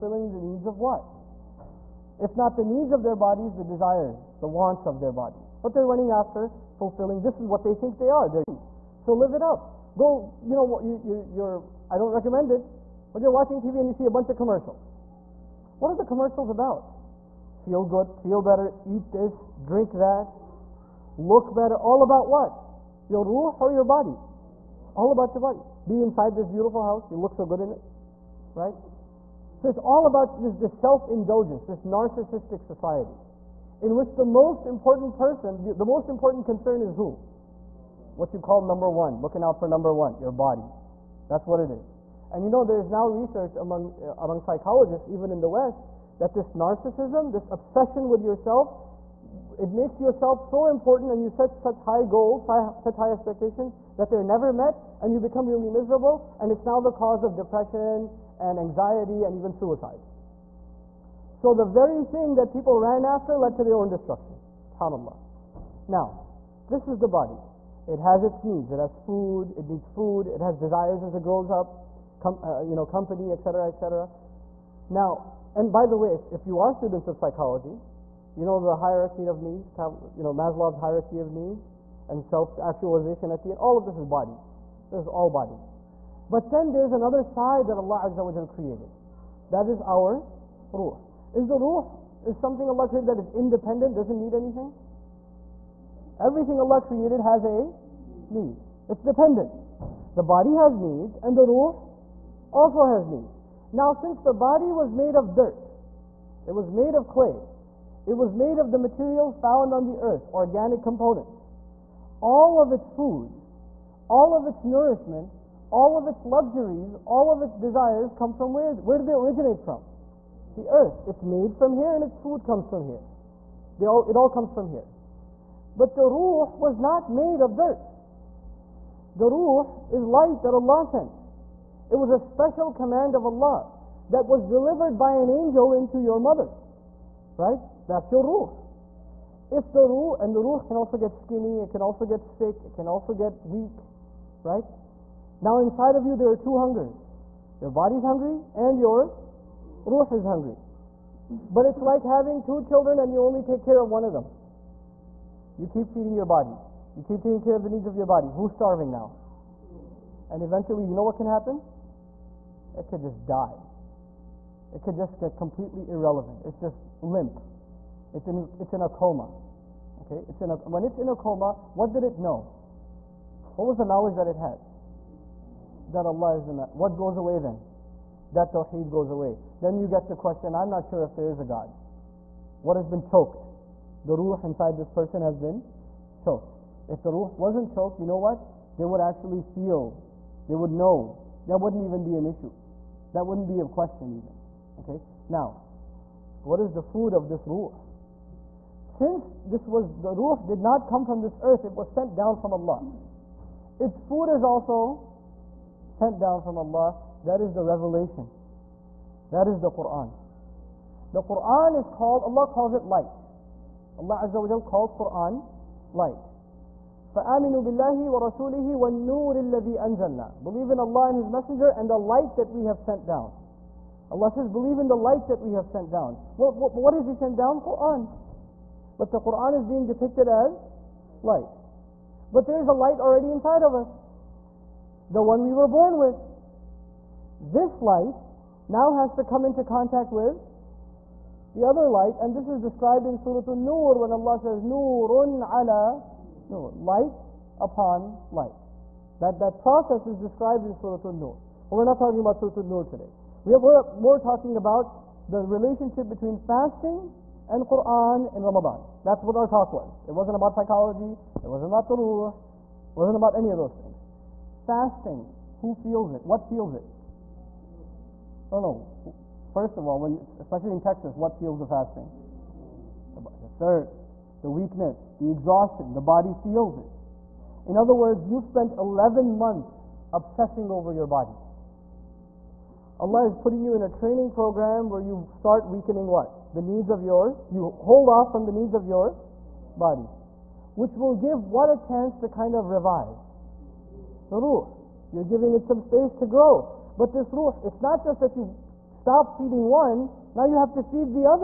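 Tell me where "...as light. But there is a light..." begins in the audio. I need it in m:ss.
3:50.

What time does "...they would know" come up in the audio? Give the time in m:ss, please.
3:10.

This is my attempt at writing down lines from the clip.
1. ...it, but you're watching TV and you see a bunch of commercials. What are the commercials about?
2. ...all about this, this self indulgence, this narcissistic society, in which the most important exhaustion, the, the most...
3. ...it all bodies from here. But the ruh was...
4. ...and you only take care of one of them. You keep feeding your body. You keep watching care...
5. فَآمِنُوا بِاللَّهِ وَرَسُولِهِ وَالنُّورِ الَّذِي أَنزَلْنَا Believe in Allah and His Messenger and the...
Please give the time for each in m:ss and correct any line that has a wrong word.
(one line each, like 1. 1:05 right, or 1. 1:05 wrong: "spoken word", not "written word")
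1. 0:12 right
2. 0:29 wrong: "person", not "exhaustion"
3. 2:04 wrong: "comes", not "bodies"
4. 2:32 wrong: "taking", not "watching"
5. 3:37 right.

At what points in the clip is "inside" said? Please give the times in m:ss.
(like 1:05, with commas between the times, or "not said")
0:26, 2:25, 3:04, 3:53.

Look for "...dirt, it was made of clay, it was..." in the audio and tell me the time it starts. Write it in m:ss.
1:45.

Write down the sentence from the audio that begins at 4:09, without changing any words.
That, that process is described in Surah An-Nur.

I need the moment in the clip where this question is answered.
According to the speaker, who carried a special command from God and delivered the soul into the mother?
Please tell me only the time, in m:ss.
2:14.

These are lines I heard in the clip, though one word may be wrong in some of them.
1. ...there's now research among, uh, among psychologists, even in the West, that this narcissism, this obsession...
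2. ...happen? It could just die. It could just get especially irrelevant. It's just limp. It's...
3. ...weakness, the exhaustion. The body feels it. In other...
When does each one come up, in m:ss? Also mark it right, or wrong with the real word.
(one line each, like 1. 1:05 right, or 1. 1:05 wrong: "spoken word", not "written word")
1. 0:42 right
2. 2:41 wrong: "completely", not "especially"
3. 4:34 right.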